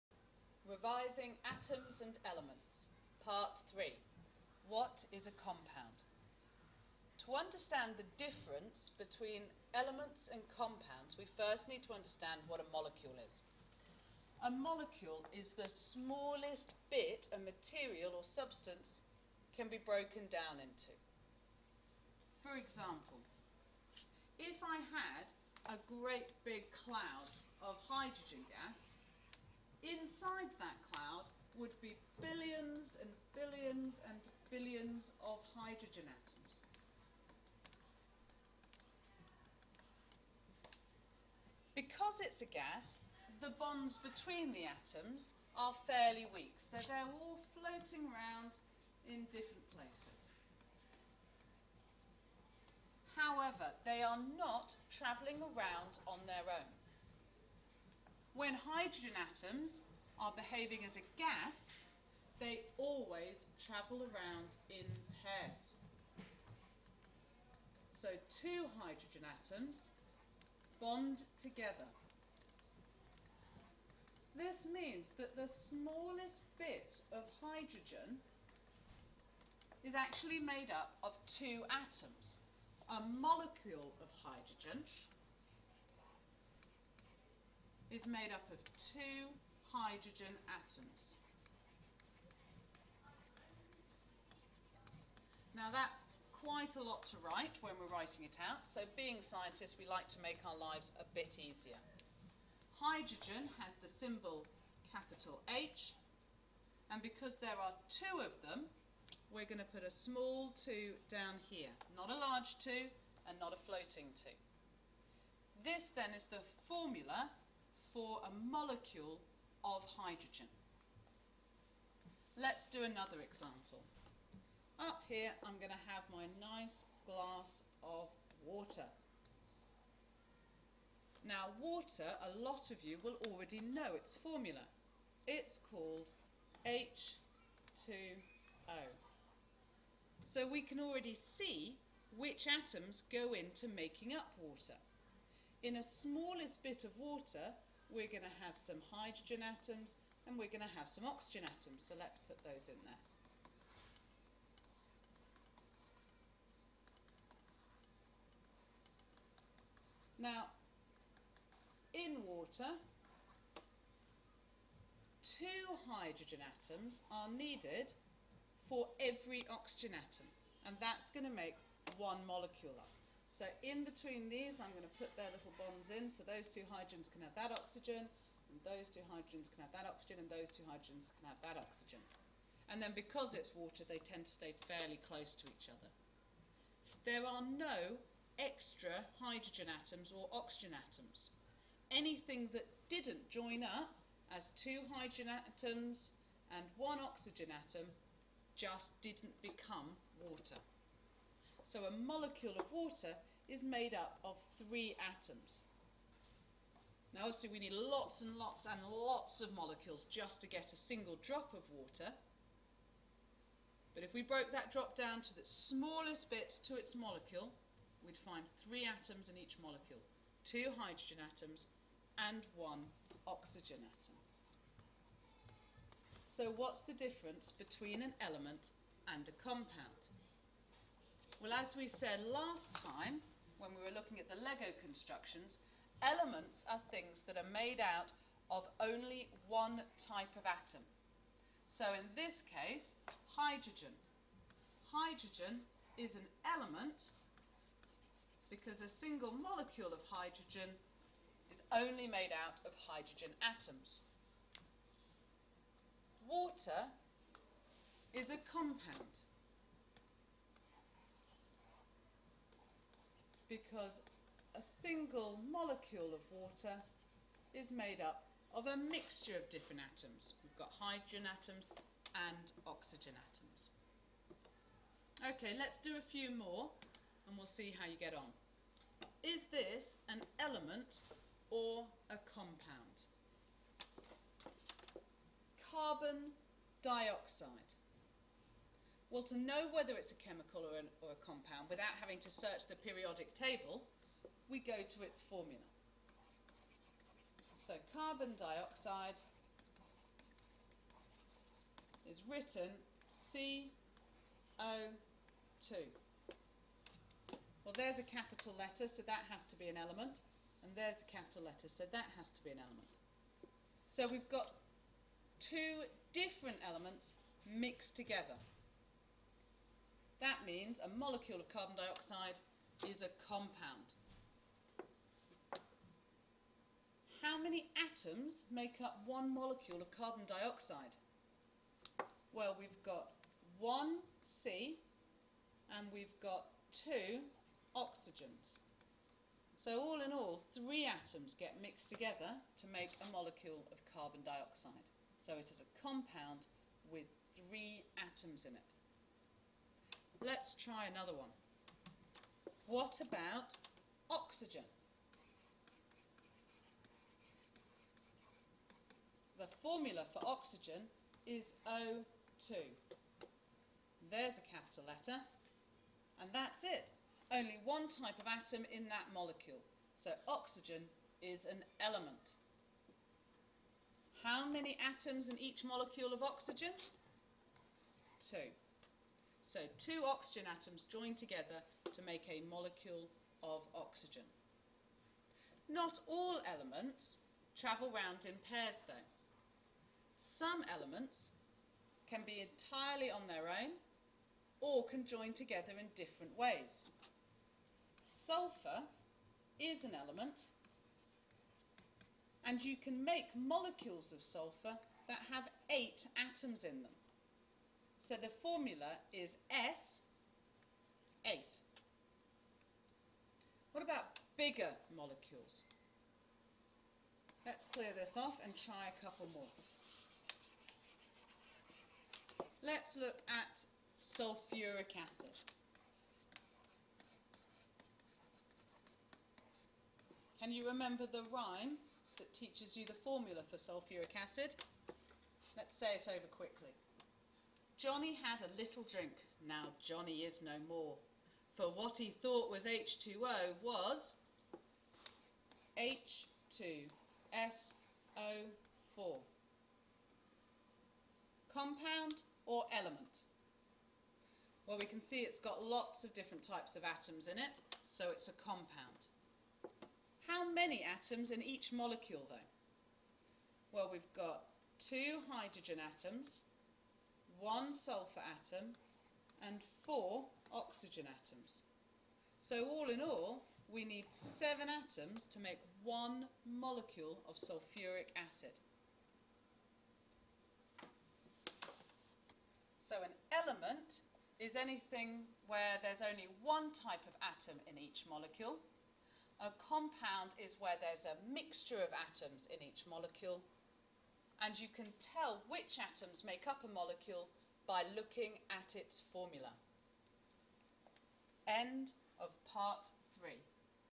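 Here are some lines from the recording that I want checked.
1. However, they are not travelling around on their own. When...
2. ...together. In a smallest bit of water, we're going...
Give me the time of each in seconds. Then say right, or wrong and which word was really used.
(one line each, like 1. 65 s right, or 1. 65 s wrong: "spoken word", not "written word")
1. 53 s right
2. 144 s wrong: "water", not "together".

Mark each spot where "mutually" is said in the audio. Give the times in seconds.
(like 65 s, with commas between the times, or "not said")
not said.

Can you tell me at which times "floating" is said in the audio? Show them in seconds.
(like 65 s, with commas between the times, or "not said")
47 s, 113 s.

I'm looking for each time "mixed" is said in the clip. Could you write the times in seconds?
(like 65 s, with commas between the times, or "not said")
317 s, 341 s.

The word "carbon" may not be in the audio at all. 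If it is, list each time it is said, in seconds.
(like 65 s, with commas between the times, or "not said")
285 s, 297 s, 321 s, 329 s, 343 s.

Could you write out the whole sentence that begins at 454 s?
Well, we can see it's got lots of different types of atoms in it, so it's a compound.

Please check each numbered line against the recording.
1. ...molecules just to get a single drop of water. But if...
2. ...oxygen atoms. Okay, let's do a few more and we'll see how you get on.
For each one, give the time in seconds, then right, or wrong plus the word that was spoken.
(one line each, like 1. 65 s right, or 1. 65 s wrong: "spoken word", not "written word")
1. 209 s right
2. 272 s right.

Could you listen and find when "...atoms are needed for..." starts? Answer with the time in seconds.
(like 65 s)
166 s.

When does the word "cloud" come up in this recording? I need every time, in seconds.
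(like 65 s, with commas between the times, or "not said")
26 s, 30 s.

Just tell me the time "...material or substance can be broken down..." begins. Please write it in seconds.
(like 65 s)
17 s.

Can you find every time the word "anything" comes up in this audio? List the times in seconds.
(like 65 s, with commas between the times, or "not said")
191 s, 484 s.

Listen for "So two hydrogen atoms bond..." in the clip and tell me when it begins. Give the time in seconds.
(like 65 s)
68 s.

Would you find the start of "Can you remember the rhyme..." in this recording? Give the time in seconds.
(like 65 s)
430 s.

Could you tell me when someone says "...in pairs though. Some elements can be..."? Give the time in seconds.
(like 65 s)
388 s.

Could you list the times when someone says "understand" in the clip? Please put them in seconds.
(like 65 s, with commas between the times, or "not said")
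7 s, 11 s.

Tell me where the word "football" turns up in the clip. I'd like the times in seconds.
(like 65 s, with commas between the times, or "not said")
not said.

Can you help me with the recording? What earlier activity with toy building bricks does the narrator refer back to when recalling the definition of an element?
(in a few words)
Lego constructions.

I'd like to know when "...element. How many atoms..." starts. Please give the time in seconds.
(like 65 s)
371 s.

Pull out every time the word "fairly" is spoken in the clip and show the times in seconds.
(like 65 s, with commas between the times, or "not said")
45 s, 184 s.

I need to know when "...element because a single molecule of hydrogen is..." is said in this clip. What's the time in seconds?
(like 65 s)
246 s.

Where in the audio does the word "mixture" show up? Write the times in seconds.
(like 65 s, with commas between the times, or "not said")
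268 s, 491 s.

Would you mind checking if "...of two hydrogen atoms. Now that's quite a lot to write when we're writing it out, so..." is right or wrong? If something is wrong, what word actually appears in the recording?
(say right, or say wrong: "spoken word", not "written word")
right.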